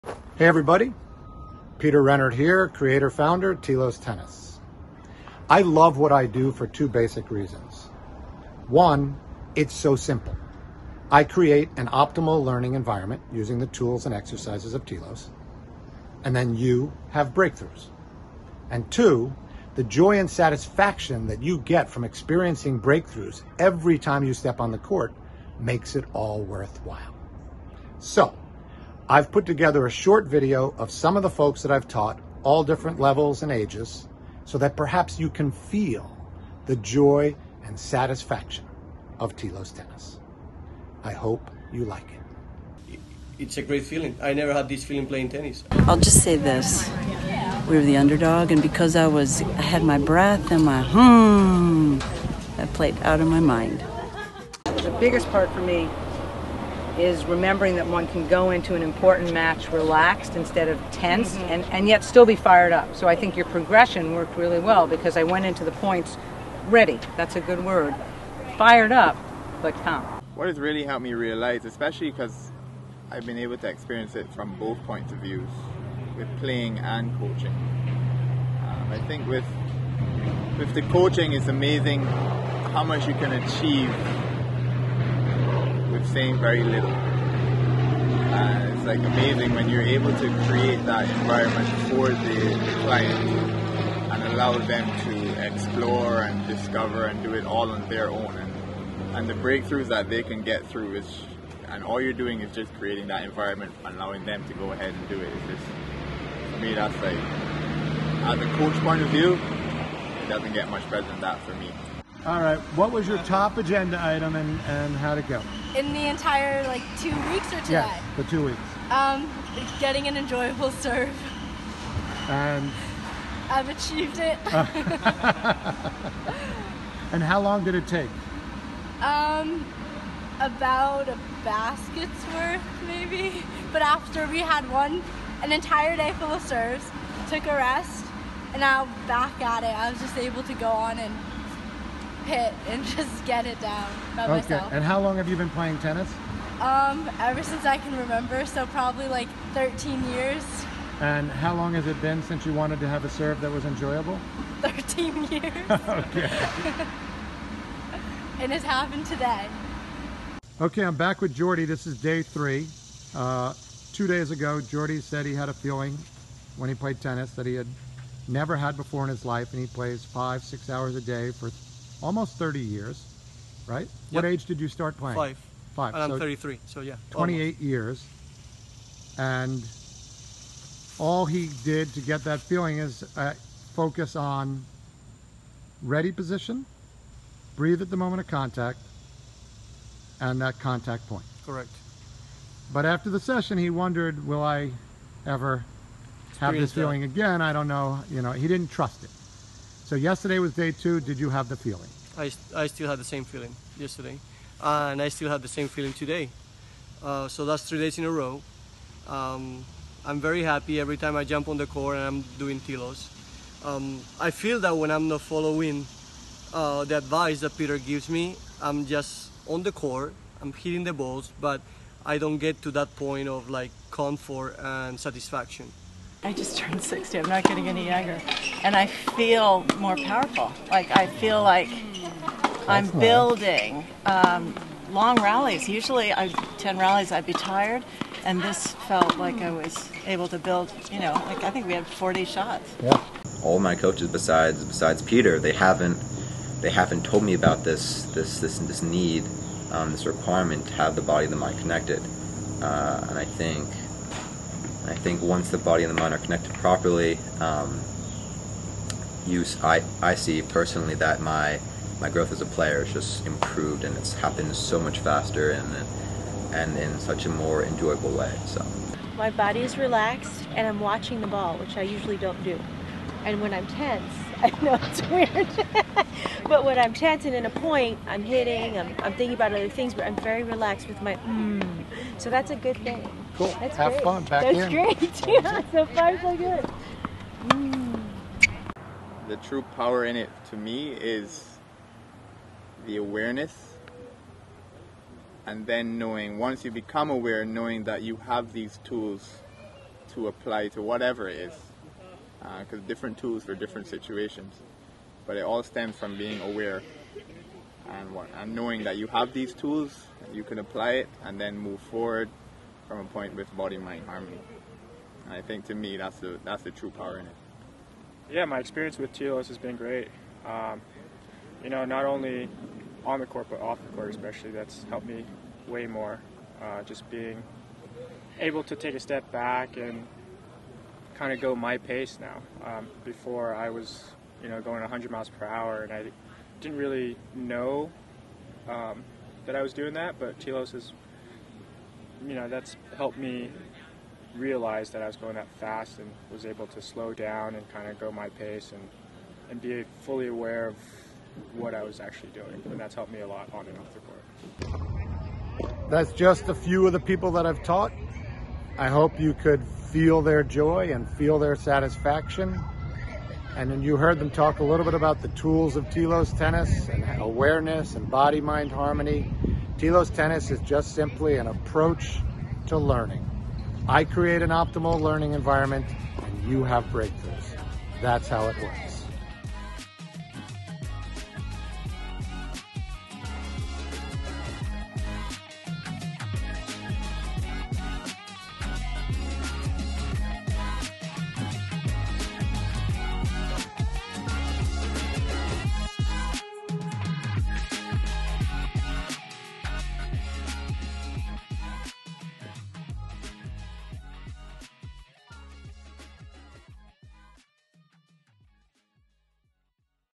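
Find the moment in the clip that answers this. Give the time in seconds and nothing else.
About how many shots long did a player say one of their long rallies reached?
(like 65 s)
241 s.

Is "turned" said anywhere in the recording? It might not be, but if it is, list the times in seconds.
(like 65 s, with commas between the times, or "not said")
226 s.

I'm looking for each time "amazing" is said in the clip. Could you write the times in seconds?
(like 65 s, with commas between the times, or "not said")
81 s, 88 s.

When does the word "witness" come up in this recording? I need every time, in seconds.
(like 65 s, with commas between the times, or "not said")
not said.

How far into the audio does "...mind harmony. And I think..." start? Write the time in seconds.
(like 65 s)
313 s.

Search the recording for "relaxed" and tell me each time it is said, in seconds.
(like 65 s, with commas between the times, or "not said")
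59 s, 269 s, 280 s.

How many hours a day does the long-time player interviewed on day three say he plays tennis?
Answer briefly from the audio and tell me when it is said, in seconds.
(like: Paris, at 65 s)
5 to 6, at 170 s.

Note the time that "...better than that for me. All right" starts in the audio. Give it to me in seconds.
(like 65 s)
110 s.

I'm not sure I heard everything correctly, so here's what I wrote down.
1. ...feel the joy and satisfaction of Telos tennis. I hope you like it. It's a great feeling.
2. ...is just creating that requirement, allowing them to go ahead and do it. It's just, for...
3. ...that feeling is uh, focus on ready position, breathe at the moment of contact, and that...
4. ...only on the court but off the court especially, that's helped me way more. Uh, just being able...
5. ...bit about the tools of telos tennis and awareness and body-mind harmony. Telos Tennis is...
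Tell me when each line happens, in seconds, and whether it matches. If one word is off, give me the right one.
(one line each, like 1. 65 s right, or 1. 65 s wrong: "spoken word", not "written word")
1. 35 s right
2. 102 s wrong: "environment", not "requirement"
3. 182 s right
4. 322 s right
5. 364 s right.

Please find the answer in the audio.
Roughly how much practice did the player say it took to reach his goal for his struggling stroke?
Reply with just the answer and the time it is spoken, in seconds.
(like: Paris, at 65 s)
a basket's worth, at 131 s.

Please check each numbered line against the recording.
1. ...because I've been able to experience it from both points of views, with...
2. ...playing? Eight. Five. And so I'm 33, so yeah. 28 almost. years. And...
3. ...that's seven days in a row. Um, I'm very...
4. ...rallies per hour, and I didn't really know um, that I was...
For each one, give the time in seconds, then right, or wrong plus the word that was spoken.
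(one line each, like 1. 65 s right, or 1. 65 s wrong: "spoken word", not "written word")
1. 72 s right
2. 174 s wrong: "Five", not "Eight"
3. 207 s wrong: "three", not "seven"
4. 335 s wrong: "miles", not "rallies".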